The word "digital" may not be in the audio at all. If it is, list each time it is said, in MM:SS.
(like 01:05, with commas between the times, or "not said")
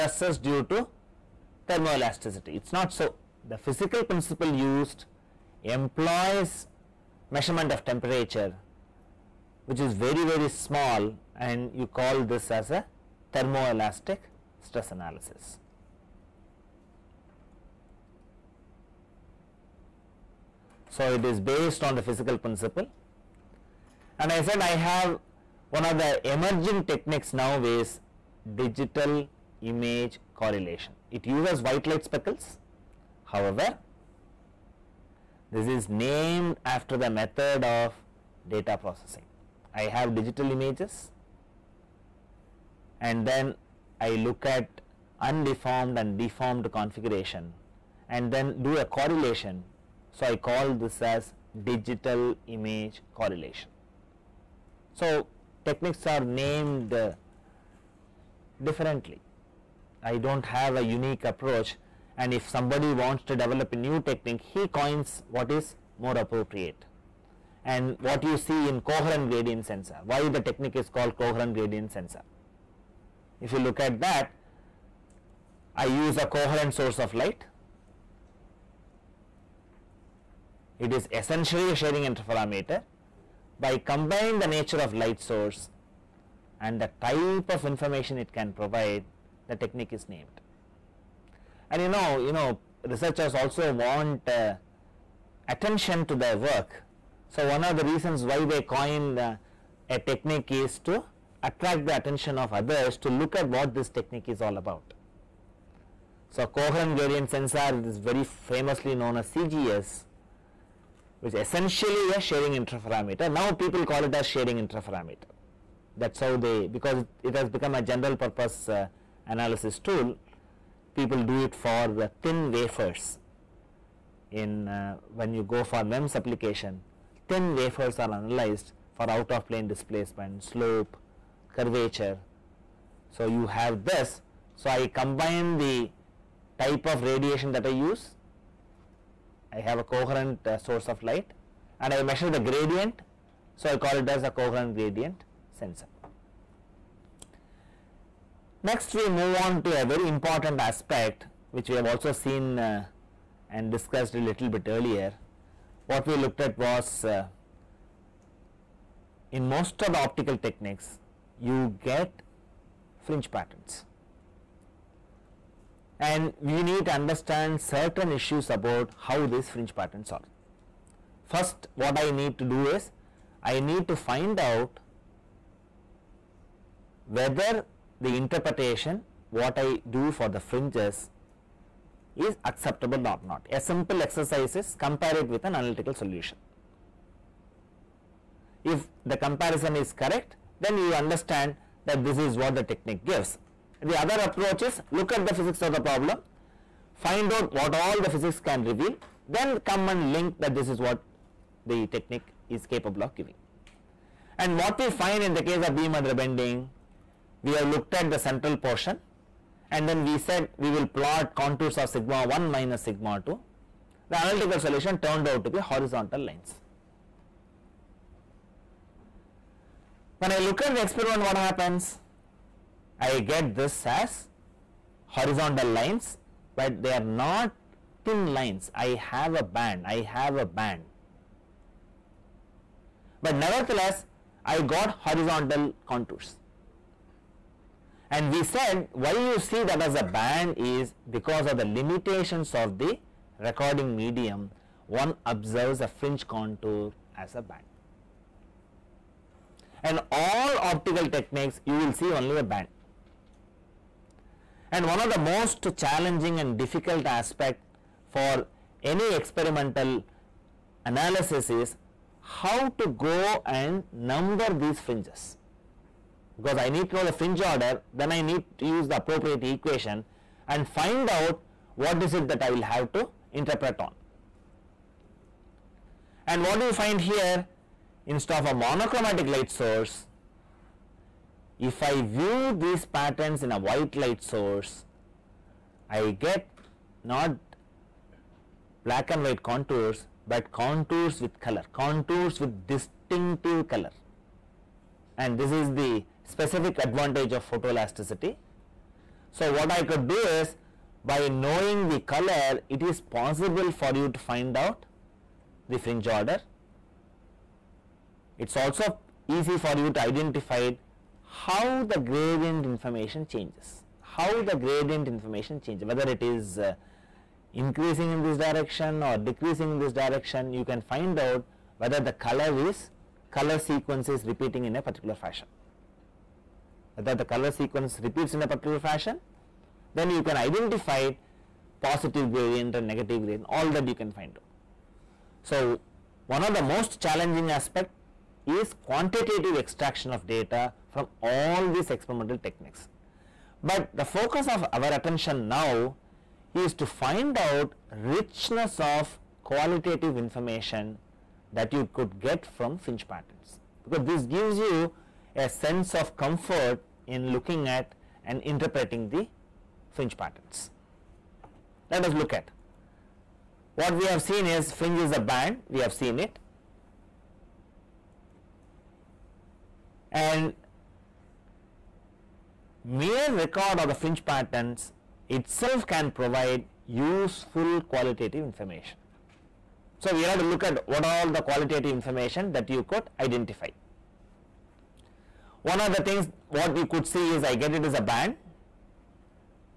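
00:28, 00:40, 00:51.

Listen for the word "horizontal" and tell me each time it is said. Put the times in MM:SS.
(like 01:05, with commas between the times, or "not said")
03:35, 03:45, 03:55.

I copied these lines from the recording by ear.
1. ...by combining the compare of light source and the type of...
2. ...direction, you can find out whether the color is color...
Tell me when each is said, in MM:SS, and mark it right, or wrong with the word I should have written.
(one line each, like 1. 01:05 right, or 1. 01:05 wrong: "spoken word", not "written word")
1. 01:23 wrong: "nature", not "compare"
2. 05:19 right.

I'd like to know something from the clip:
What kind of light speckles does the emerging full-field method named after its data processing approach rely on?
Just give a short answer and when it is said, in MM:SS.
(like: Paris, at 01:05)
White light speckles, at 00:31.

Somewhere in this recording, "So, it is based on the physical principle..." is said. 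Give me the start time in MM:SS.
00:20.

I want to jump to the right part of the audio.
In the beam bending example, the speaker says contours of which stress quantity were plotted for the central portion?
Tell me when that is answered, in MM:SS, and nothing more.
03:31.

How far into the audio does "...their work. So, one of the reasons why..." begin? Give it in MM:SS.
01:36.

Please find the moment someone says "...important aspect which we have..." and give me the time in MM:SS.
02:30.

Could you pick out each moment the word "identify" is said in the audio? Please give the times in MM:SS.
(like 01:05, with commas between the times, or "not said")
05:09, 05:30, 06:23.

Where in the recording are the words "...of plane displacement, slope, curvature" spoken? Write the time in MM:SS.
02:09.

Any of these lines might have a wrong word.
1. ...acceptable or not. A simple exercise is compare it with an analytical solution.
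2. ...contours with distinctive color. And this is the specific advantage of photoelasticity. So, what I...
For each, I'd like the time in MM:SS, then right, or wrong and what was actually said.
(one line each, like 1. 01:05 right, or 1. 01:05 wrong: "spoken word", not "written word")
1. 03:02 right
2. 04:51 right.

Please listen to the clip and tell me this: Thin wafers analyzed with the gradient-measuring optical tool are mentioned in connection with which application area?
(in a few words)
MEMS.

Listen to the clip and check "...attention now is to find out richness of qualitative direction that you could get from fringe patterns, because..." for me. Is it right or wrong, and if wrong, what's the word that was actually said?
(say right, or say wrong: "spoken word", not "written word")
wrong: "information", not "direction".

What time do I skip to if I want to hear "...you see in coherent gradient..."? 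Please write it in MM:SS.
01:08.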